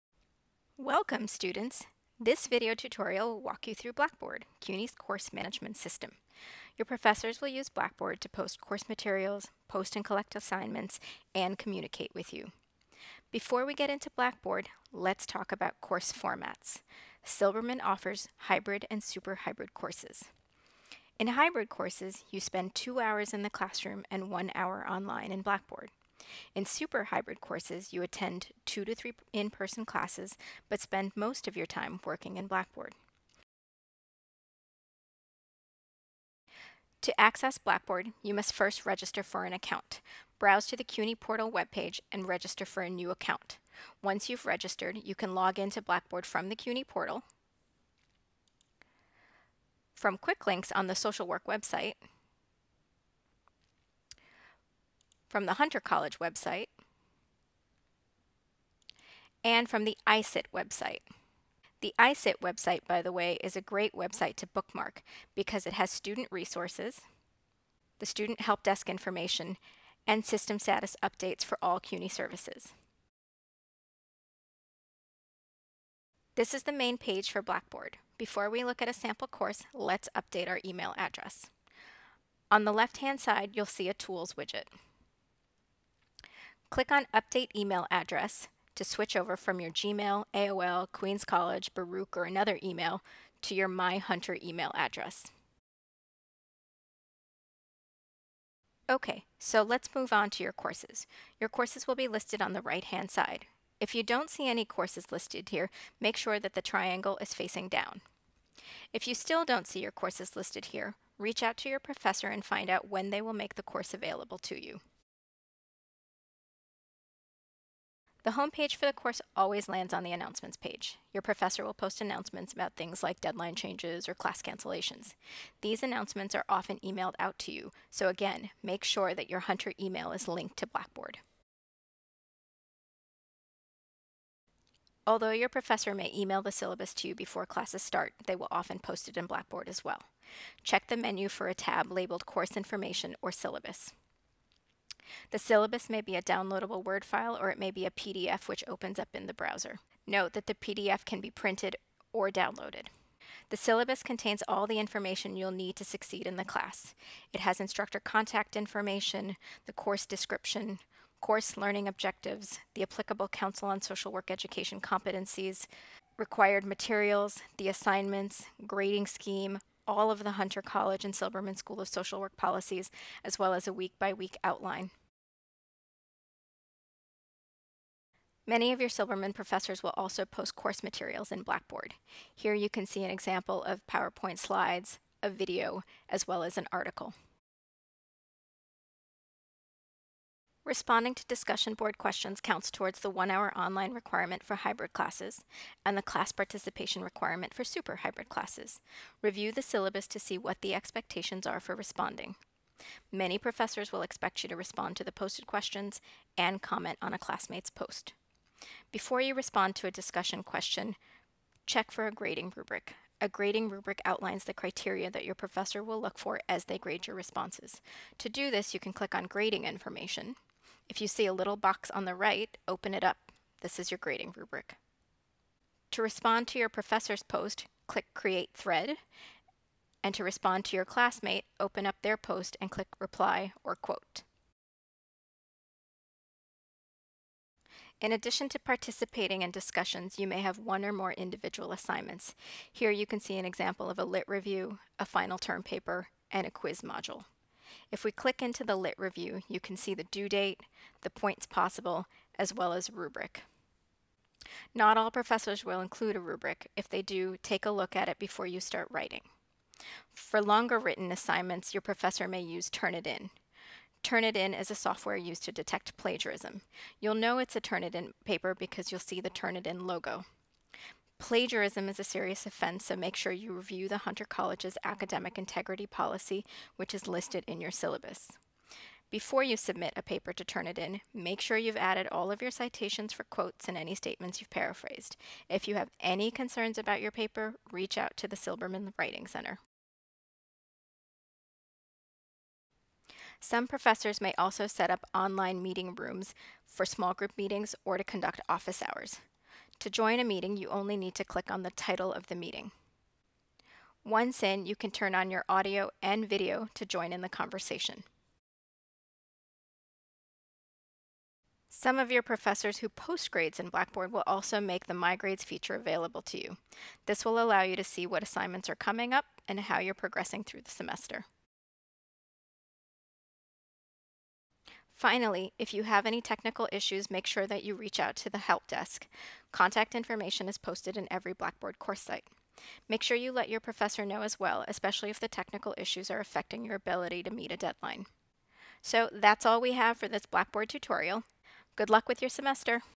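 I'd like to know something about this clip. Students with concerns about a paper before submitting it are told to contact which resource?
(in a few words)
Silberman Writing Center.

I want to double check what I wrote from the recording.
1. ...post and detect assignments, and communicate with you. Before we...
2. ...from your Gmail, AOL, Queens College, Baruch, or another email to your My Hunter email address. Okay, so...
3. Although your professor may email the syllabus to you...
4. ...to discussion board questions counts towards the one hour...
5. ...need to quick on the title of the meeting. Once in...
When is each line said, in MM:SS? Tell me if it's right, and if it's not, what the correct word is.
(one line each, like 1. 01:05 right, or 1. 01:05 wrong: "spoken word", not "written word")
1. 00:09 wrong: "collect", not "detect"
2. 01:29 right
3. 02:15 right
4. 03:11 right
5. 05:00 wrong: "click", not "quick".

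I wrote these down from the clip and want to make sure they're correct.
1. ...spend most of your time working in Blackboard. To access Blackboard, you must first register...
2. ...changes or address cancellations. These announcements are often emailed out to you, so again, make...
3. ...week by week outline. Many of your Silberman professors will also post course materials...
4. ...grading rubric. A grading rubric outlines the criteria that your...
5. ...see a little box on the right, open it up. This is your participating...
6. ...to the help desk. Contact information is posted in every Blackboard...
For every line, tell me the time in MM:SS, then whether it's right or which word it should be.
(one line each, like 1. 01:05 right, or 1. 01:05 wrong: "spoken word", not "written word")
1. 00:30 right
2. 02:03 wrong: "class", not "address"
3. 02:53 right
4. 03:32 right
5. 03:41 wrong: "grading", not "participating"
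6. 05:28 right.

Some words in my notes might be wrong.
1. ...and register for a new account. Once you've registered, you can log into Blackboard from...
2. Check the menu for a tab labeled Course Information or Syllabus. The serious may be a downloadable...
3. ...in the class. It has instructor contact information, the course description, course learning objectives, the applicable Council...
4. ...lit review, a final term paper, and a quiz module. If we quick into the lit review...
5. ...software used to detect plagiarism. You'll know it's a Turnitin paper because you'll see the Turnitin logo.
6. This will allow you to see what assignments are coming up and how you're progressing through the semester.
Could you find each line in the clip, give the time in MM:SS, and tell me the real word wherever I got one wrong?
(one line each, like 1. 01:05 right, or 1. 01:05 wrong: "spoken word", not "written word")
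1. 00:42 right
2. 02:20 wrong: "syllabus", not "serious"
3. 02:36 right
4. 04:04 wrong: "click", not "quick"
5. 04:24 right
6. 05:17 right.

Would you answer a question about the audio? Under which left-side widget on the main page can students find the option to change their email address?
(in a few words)
Tools.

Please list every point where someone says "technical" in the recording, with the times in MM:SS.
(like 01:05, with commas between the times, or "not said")
05:26, 05:35.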